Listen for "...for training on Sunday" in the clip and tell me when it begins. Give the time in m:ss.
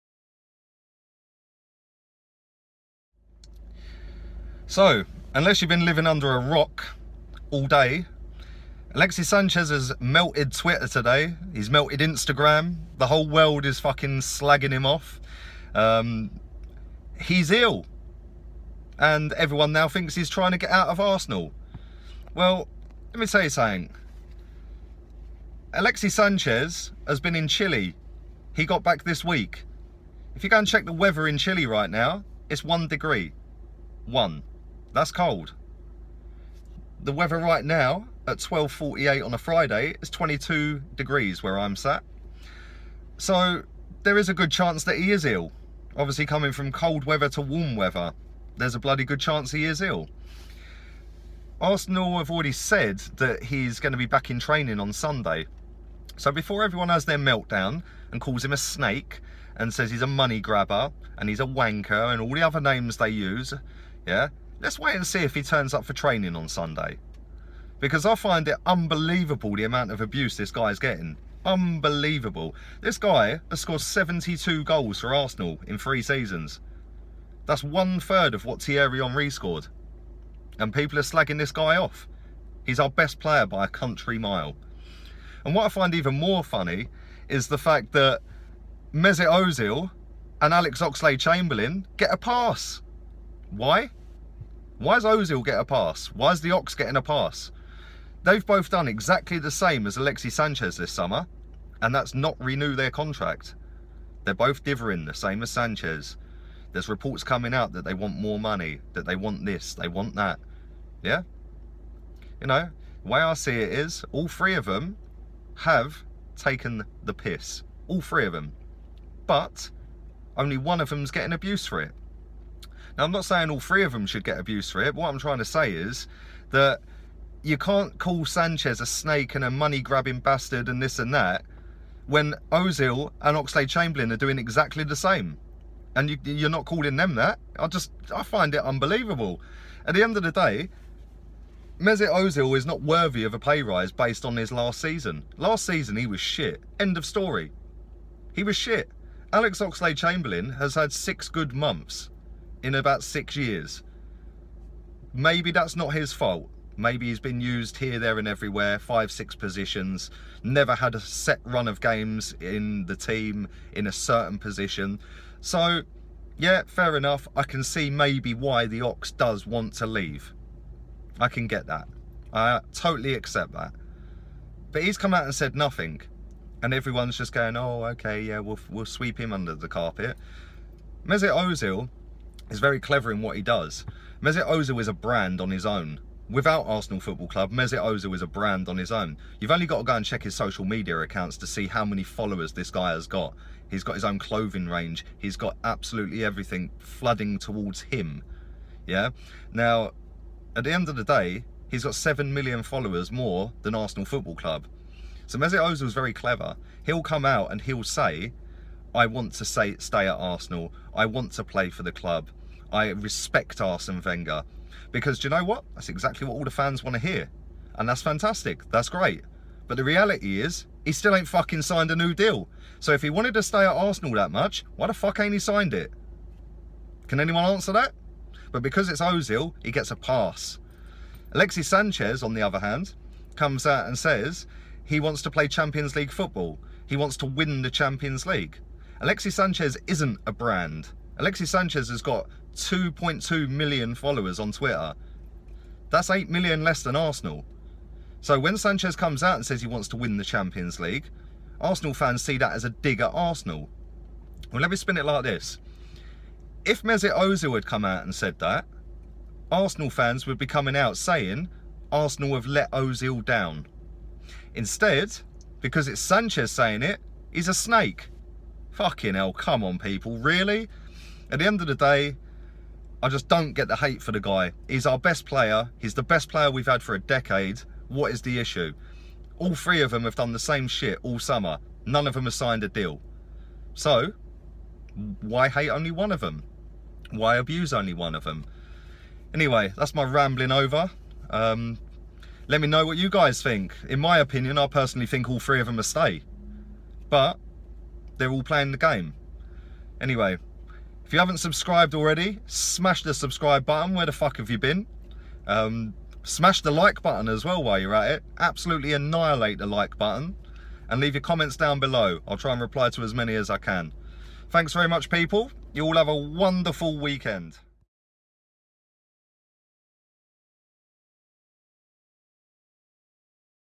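1:05.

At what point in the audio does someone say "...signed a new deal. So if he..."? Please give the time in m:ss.
3:41.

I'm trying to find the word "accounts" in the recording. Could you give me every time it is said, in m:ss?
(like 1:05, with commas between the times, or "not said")
3:10.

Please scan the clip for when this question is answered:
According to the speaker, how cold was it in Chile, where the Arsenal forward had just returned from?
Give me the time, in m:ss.
0:32.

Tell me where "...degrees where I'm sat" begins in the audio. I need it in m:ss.
0:40.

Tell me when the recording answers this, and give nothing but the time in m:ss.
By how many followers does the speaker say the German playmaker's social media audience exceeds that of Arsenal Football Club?
3:21.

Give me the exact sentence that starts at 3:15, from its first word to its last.
He's got absolutely everything flooding towards him.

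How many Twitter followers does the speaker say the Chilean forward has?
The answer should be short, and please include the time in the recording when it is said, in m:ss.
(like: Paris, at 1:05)
2.2 million, at 4:02.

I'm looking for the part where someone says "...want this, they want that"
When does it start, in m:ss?
1:49.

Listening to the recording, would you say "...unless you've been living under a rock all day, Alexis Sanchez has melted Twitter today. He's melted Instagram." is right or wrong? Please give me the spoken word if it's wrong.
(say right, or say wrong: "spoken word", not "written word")
right.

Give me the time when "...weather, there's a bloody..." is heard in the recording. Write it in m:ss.
0:47.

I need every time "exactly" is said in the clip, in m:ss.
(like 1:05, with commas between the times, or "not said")
1:38, 2:14, 3:35.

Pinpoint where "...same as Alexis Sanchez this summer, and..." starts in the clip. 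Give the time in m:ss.
1:39.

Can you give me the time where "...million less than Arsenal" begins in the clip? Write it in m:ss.
4:06.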